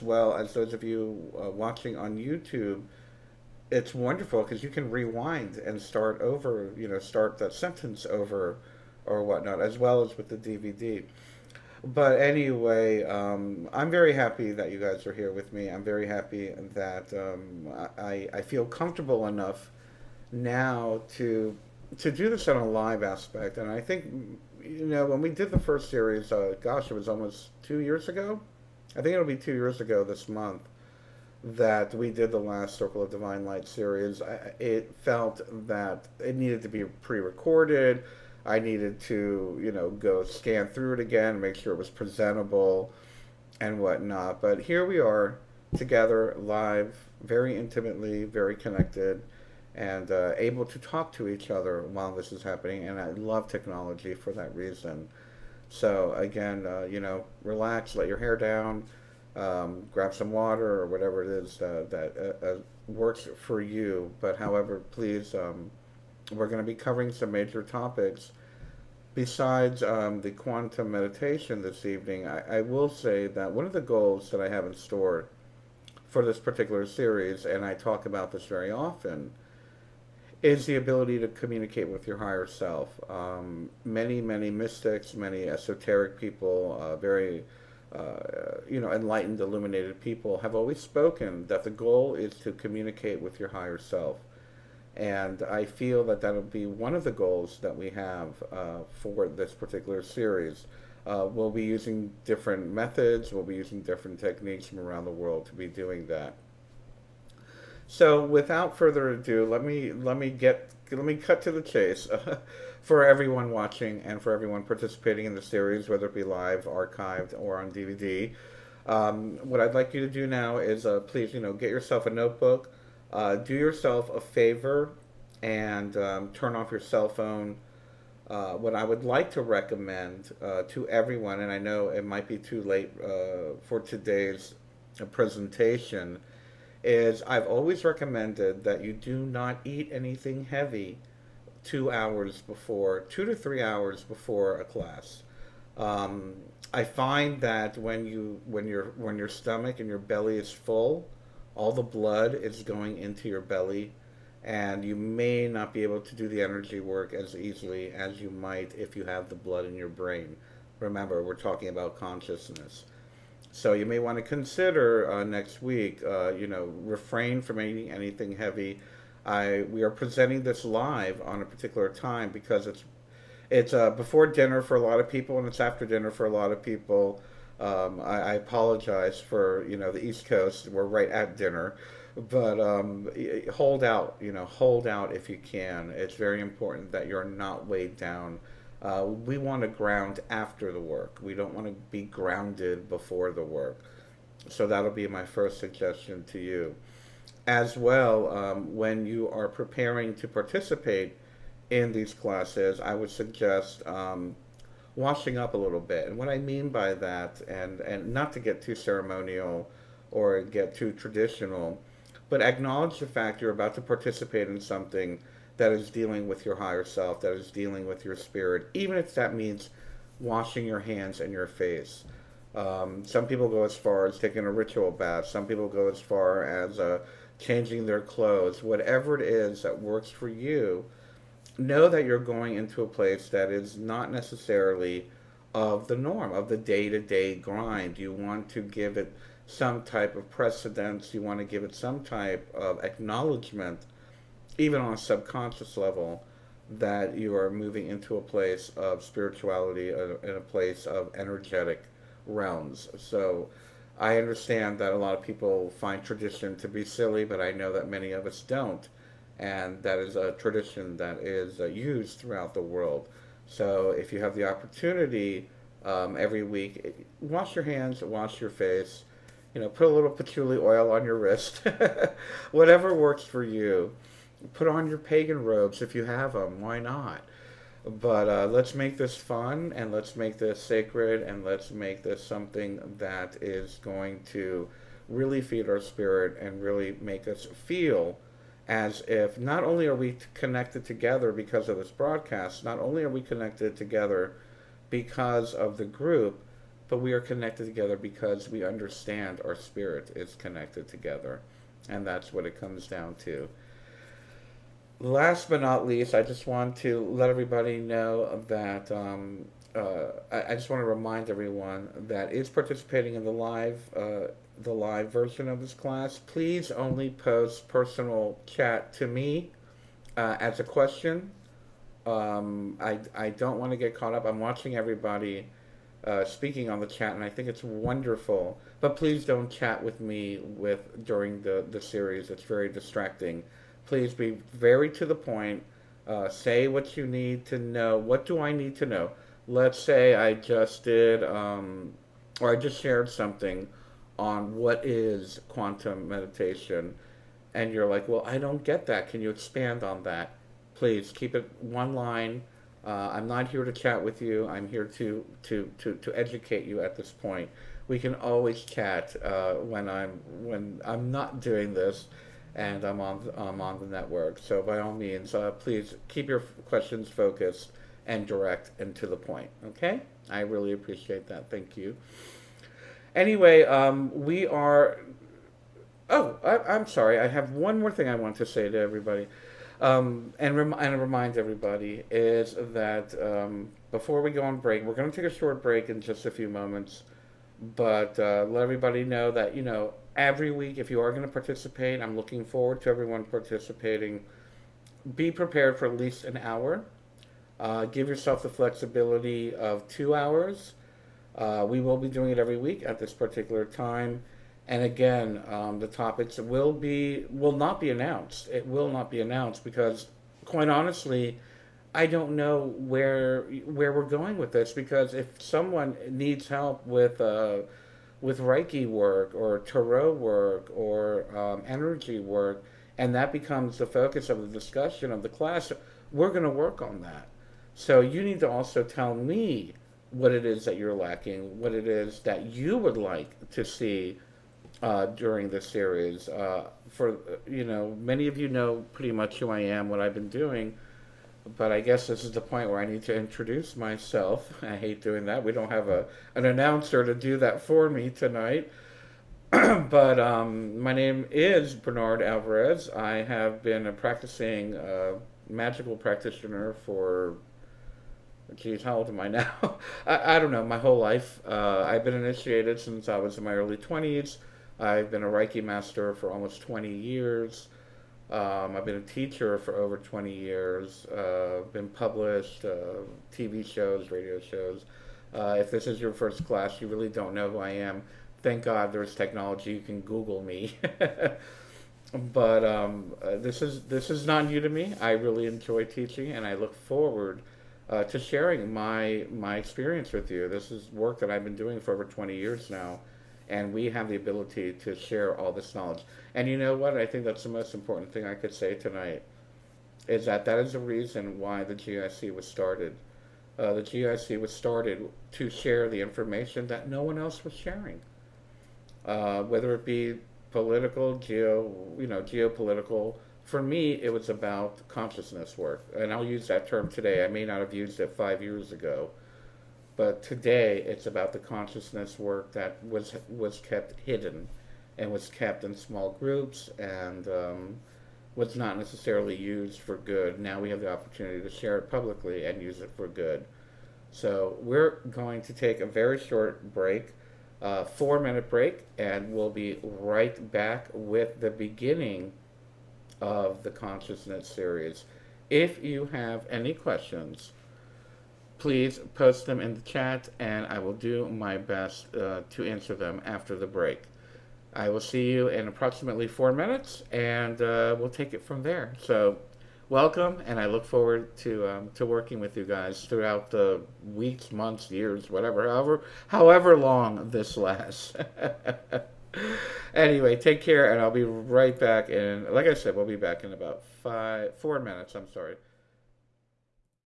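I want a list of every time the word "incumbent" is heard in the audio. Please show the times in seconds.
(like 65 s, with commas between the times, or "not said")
not said.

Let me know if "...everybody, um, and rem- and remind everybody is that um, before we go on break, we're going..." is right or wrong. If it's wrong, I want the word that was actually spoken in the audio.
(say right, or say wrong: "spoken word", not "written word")
right.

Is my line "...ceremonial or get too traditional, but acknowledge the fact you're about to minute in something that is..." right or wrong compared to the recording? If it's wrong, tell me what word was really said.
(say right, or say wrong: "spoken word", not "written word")
wrong: "participate", not "minute".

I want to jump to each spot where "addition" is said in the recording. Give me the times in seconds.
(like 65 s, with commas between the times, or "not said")
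not said.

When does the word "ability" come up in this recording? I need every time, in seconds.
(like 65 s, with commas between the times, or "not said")
80 s, 494 s.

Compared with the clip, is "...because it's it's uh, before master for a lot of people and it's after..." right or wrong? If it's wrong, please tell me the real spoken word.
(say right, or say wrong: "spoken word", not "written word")
wrong: "dinner", not "master".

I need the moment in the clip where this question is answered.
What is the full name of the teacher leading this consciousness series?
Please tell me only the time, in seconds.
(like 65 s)
451 s.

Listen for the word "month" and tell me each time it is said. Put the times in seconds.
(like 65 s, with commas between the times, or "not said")
30 s, 564 s.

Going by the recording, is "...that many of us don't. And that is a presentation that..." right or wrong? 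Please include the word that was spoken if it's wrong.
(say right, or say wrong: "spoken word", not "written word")
wrong: "tradition", not "presentation".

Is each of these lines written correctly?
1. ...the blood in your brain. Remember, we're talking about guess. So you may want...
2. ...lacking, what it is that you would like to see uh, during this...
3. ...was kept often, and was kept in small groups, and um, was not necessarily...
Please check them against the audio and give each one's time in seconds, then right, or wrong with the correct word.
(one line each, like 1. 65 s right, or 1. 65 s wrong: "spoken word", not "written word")
1. 159 s wrong: "consciousness", not "guess"
2. 430 s right
3. 523 s wrong: "hidden", not "often".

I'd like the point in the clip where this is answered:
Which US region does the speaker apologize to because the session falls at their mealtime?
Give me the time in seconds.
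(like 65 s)
180 s.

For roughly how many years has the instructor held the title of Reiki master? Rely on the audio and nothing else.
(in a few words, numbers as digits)
almost 20 years.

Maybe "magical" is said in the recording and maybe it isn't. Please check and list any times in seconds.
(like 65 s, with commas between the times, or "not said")
455 s.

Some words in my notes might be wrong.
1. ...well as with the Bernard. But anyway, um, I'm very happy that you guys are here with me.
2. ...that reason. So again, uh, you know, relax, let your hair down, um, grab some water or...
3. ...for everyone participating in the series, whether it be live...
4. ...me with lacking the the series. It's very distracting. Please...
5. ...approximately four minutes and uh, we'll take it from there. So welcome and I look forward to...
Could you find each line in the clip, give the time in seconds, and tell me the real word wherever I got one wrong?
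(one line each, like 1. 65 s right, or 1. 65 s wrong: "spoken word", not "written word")
1. 9 s wrong: "DVD", not "Bernard"
2. 54 s right
3. 114 s right
4. 330 s wrong: "during", not "lacking"
5. 555 s right.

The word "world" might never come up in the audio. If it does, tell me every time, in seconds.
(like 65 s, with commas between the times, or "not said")
105 s, 262 s.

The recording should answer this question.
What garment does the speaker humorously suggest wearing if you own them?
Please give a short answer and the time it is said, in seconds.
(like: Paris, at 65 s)
pagan robes, at 274 s.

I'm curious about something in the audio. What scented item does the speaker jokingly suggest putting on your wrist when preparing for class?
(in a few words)
patchouli oil.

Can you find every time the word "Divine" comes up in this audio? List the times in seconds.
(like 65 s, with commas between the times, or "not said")
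33 s.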